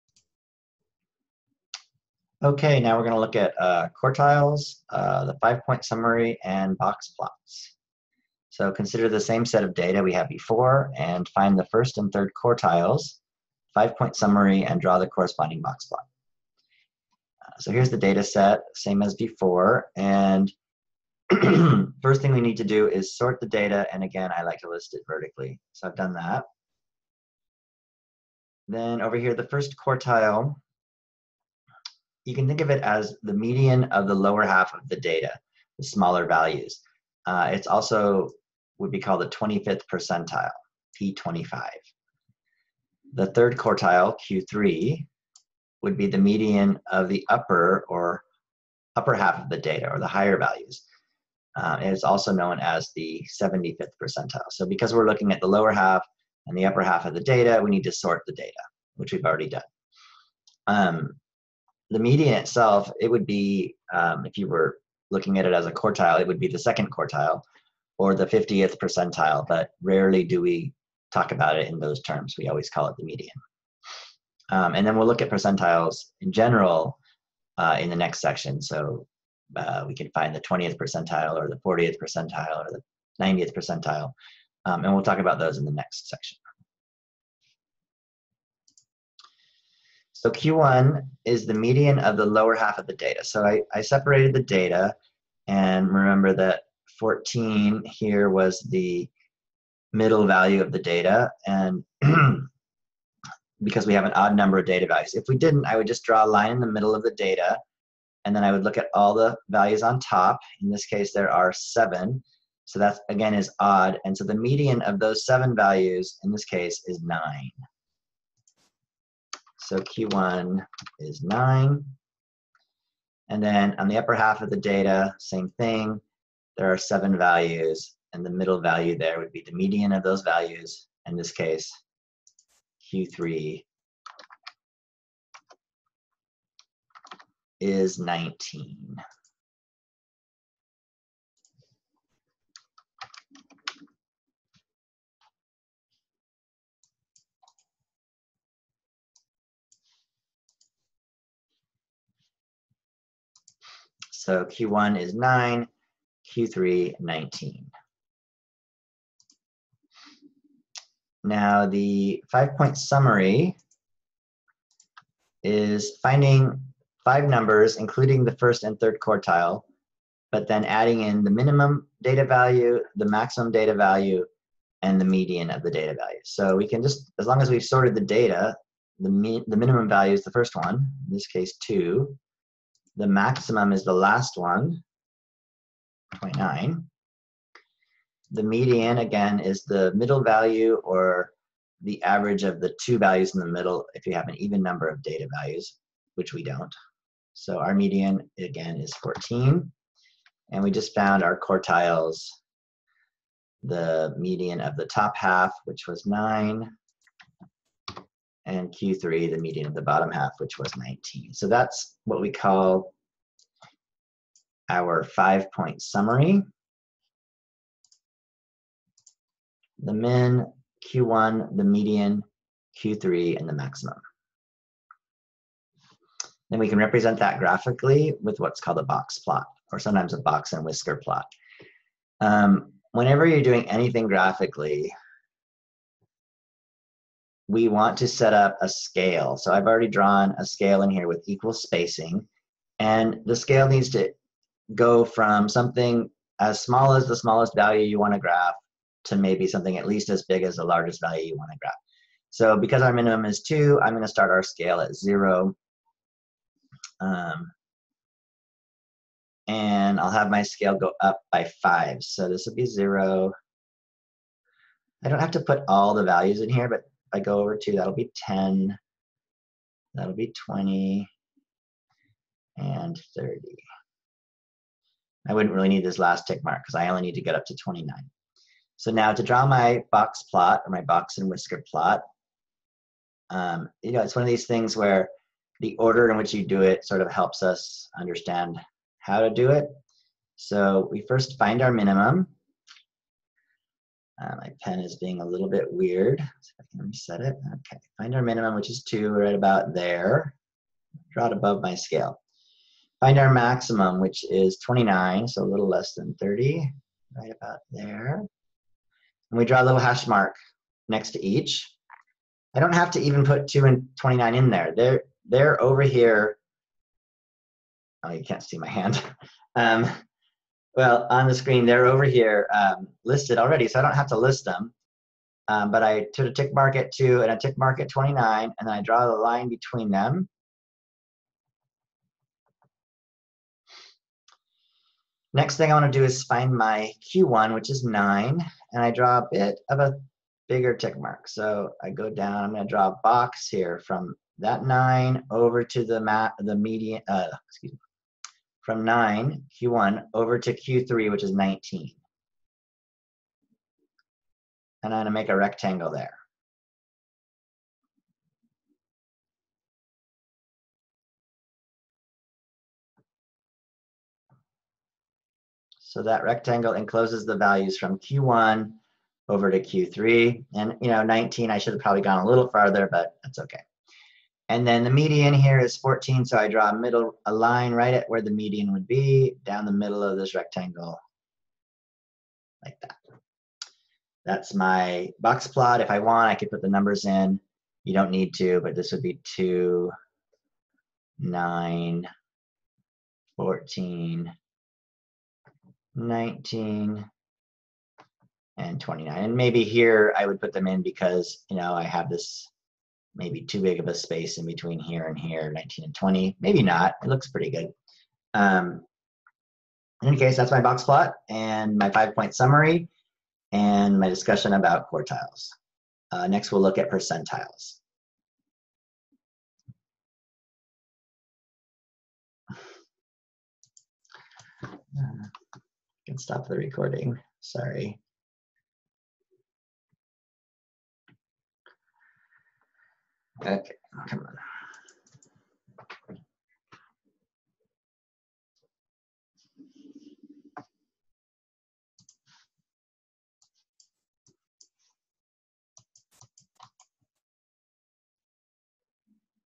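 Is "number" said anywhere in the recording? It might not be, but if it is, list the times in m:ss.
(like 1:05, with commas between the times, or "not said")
1:44, 2:47, 3:14, 6:26.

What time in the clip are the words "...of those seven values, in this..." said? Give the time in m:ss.
1:54.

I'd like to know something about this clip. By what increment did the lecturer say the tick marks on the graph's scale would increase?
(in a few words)
5.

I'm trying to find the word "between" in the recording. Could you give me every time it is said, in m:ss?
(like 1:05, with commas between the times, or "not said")
5:29, 6:44.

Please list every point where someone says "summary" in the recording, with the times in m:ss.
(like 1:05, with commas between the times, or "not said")
0:05, 0:14, 2:42, 3:35, 6:52.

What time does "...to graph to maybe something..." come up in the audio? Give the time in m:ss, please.
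4:08.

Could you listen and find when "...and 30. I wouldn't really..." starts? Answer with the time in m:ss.
4:32.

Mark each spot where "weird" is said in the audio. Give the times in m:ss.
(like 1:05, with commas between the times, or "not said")
4:55.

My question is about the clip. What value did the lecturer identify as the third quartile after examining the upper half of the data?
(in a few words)
19.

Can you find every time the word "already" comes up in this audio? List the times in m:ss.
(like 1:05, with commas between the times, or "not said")
0:59, 3:59, 5:23.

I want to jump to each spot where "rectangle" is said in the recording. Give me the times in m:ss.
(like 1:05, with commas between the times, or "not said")
5:55, 6:06, 6:20.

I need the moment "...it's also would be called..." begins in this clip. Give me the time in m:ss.
0:37.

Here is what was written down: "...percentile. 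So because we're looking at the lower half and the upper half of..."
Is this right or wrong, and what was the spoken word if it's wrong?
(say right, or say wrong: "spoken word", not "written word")
right.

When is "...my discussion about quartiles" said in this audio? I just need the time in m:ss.
6:53.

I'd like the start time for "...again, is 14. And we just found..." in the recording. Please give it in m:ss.
3:18.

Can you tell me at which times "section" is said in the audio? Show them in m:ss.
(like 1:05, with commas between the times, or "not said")
1:18, 1:26.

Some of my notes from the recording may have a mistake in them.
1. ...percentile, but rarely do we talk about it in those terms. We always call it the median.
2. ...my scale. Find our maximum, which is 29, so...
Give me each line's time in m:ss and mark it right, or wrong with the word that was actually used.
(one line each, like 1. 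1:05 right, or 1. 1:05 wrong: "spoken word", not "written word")
1. 1:08 right
2. 5:01 right.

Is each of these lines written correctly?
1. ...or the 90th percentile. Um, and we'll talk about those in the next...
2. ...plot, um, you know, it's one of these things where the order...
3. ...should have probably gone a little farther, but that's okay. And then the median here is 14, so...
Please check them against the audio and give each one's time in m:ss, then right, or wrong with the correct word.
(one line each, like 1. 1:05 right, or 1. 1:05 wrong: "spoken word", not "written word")
1. 1:22 right
2. 4:41 right
3. 6:11 right.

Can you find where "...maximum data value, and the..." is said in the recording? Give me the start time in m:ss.
2:53.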